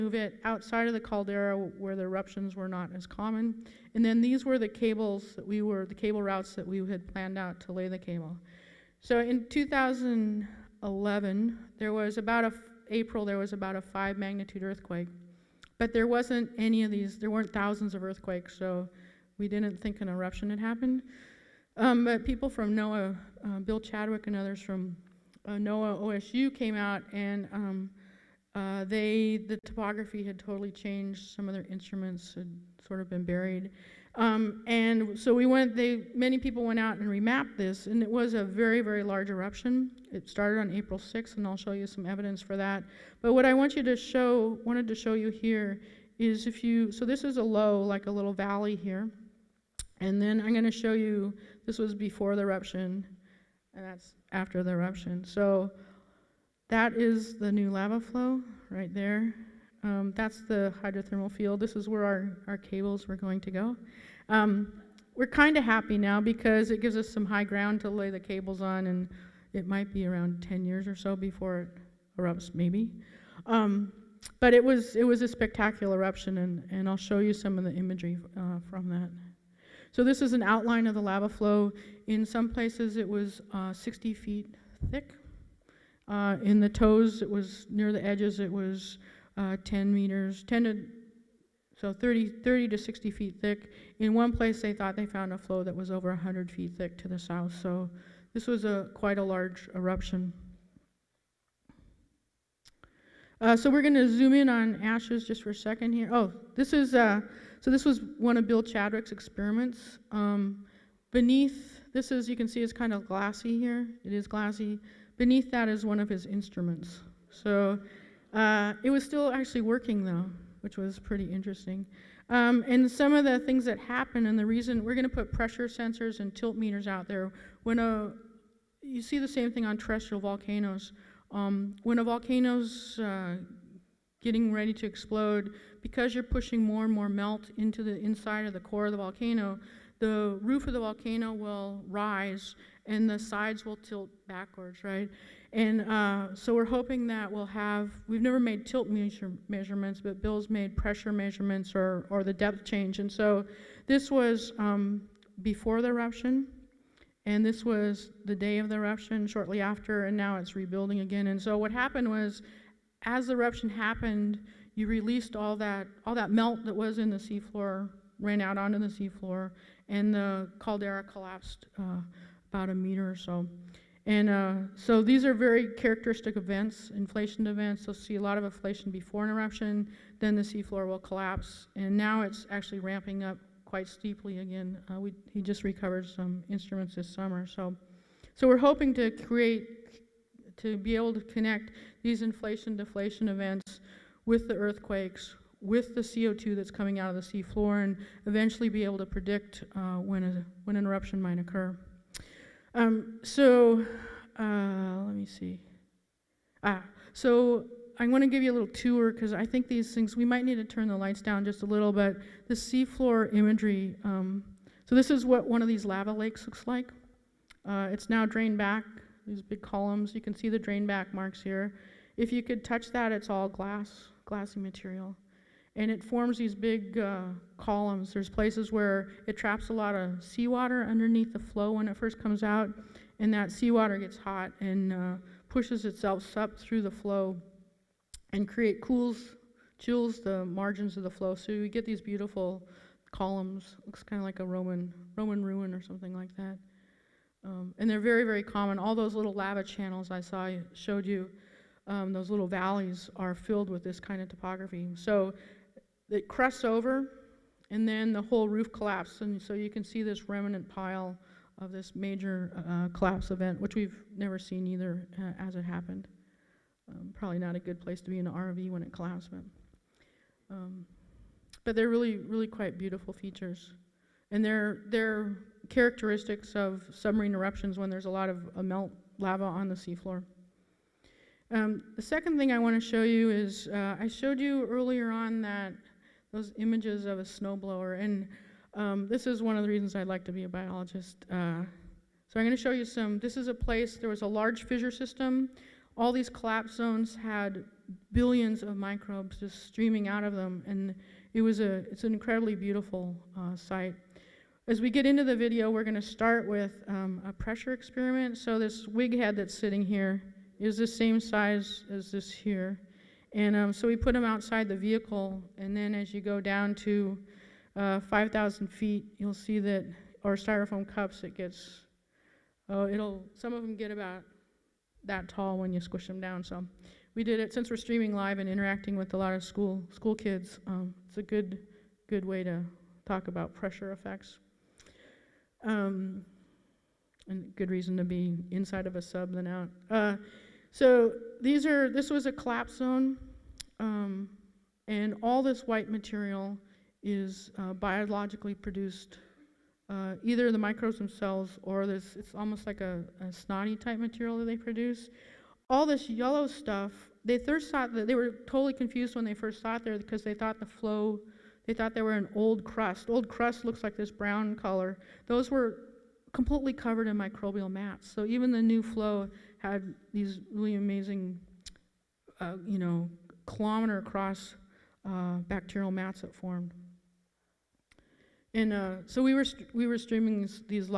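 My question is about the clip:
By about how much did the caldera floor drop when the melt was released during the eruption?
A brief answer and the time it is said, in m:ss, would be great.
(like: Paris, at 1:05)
a meter, at 2:52.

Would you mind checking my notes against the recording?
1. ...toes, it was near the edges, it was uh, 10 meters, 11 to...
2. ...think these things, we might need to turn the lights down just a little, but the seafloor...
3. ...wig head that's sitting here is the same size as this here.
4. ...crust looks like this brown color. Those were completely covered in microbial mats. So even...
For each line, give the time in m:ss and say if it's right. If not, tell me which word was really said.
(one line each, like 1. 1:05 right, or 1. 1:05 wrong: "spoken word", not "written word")
1. 1:26 wrong: "10", not "11"
2. 3:29 right
3. 5:08 right
4. 6:03 right.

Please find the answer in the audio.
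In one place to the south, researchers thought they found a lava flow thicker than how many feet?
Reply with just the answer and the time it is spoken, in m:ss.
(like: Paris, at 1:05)
100 feet, at 1:36.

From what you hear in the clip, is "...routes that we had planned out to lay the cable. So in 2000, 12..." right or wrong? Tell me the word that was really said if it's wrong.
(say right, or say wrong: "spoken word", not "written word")
wrong: "11", not "12".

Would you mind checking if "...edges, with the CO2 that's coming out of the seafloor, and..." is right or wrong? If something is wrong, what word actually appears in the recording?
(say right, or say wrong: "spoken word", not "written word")
wrong: "earthquakes", not "edges".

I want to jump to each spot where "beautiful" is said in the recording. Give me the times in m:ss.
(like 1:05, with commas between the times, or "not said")
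4:02, 4:32, 5:02.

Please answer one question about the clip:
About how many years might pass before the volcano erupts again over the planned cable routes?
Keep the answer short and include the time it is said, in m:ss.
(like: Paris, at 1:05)
10 years, at 1:10.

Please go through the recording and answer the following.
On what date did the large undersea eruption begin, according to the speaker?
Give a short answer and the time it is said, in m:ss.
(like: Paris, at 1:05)
April 6th, at 0:40.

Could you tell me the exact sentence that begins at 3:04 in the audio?
Uh, we, he just recovered some instruments this summer.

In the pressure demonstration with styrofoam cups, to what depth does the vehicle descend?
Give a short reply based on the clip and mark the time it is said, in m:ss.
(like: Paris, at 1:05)
5,000 feet, at 5:18.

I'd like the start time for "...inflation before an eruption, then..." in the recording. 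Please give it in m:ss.
2:58.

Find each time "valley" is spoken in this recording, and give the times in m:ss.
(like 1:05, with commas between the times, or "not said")
0:48, 4:12.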